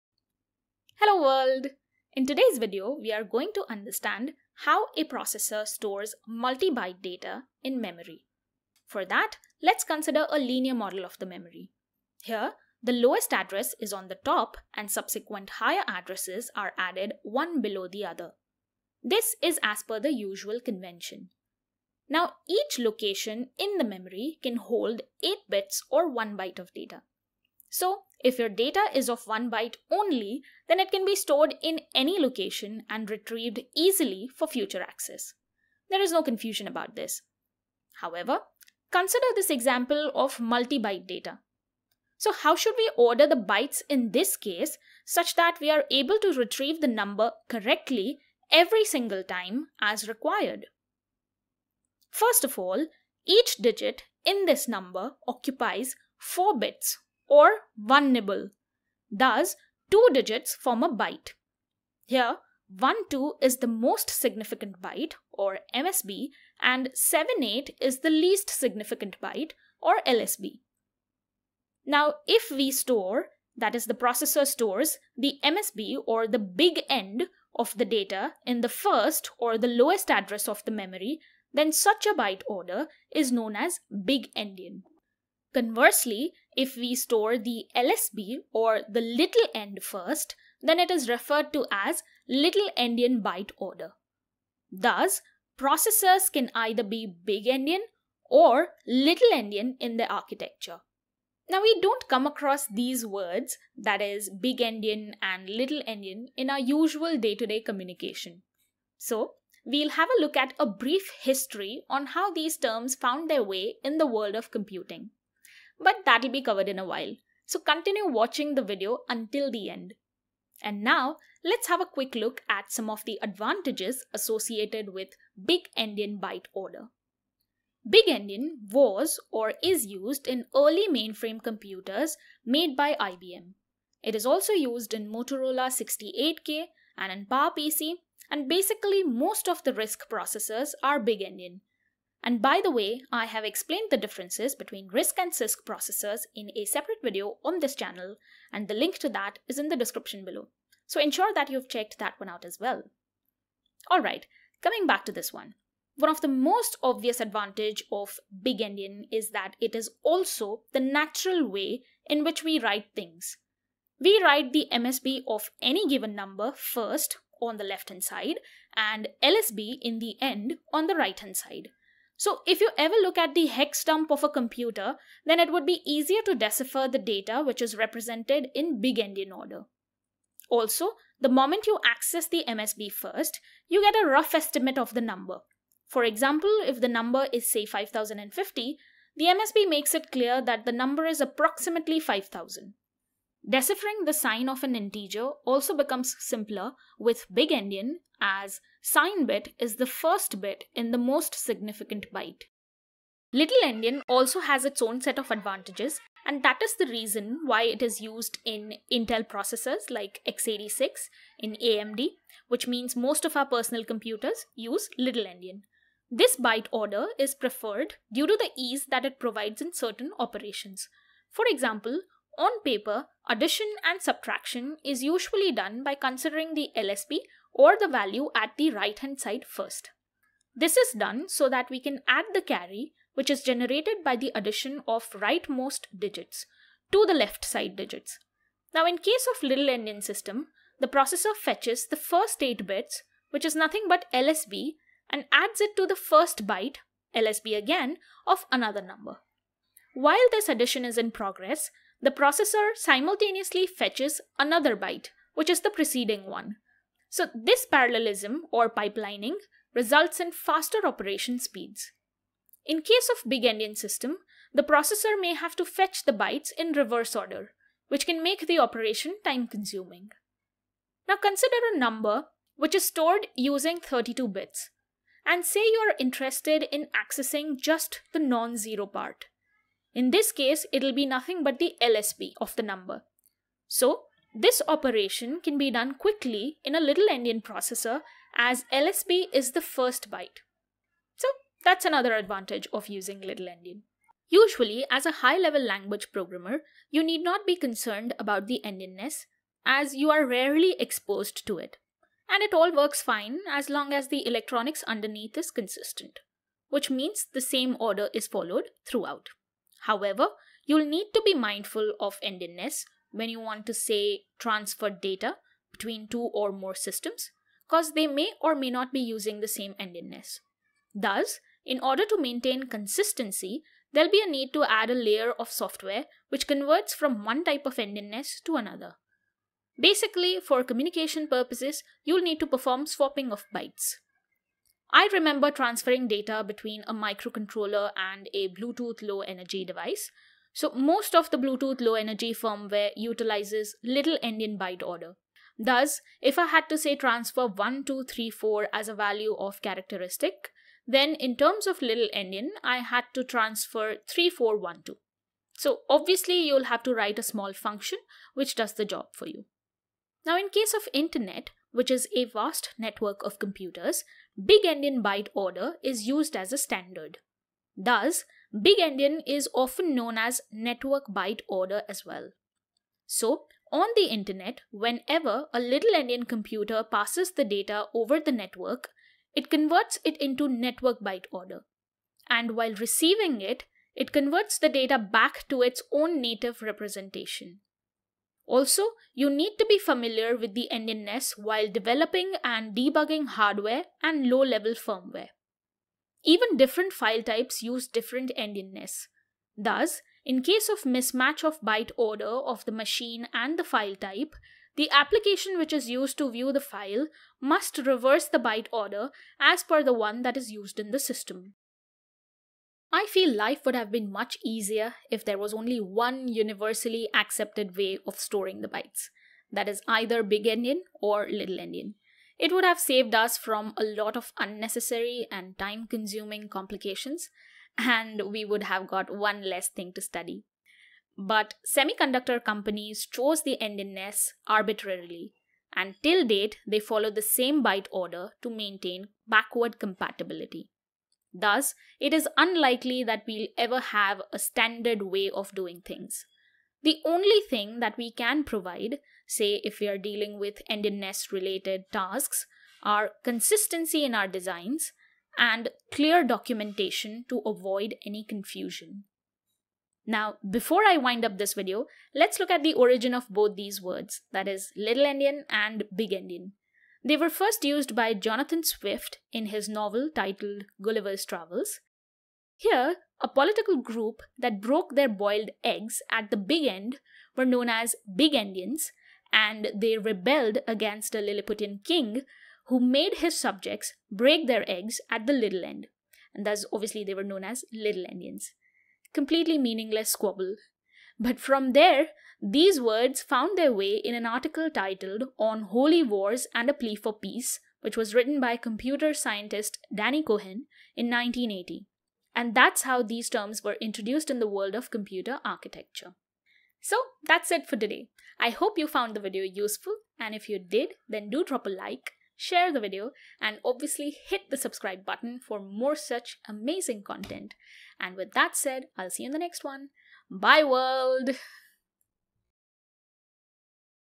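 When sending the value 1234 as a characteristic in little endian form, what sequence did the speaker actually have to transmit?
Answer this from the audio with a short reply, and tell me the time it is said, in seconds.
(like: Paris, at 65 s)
3412, at 354 s.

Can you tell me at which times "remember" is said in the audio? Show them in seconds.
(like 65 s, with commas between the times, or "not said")
335 s.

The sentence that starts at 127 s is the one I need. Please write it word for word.
Big Endian was or is used in early mainframe computers made by IBM.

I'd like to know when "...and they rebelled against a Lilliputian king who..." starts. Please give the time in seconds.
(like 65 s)
479 s.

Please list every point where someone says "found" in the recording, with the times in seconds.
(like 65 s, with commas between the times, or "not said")
112 s, 493 s, 508 s.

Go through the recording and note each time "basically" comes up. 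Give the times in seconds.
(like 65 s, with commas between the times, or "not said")
138 s, 329 s.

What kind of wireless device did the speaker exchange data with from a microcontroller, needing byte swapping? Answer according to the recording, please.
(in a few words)
Bluetooth low energy device.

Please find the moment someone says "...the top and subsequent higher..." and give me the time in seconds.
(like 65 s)
14 s.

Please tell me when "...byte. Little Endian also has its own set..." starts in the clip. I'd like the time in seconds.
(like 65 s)
202 s.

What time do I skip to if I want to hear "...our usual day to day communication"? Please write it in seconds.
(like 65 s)
106 s.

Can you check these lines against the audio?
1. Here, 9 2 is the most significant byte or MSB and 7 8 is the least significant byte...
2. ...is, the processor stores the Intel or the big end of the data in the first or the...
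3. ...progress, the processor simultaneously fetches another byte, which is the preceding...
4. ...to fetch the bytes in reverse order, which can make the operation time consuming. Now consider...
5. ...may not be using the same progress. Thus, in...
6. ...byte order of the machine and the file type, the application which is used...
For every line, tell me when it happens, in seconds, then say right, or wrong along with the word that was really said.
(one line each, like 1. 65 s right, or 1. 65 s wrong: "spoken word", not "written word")
1. 62 s wrong: "1", not "9"
2. 73 s wrong: "MSB", not "Intel"
3. 251 s right
4. 265 s right
5. 318 s wrong: "endianness", not "progress"
6. 401 s right.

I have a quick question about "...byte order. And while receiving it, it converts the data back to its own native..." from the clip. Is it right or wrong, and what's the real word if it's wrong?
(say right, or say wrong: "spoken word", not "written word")
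right.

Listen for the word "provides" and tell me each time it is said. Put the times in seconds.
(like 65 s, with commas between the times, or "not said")
219 s, 448 s.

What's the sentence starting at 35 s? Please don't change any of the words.
There is no confusion about this.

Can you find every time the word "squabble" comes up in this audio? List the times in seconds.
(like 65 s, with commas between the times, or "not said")
490 s.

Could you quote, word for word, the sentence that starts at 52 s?
First of all, each digit in this number occupies 4 bits or one nibble.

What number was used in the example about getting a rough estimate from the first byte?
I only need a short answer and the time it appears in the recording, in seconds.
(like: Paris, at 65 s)
5050, at 187 s.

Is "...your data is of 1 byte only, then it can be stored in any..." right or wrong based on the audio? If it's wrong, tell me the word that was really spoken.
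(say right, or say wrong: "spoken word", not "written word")
right.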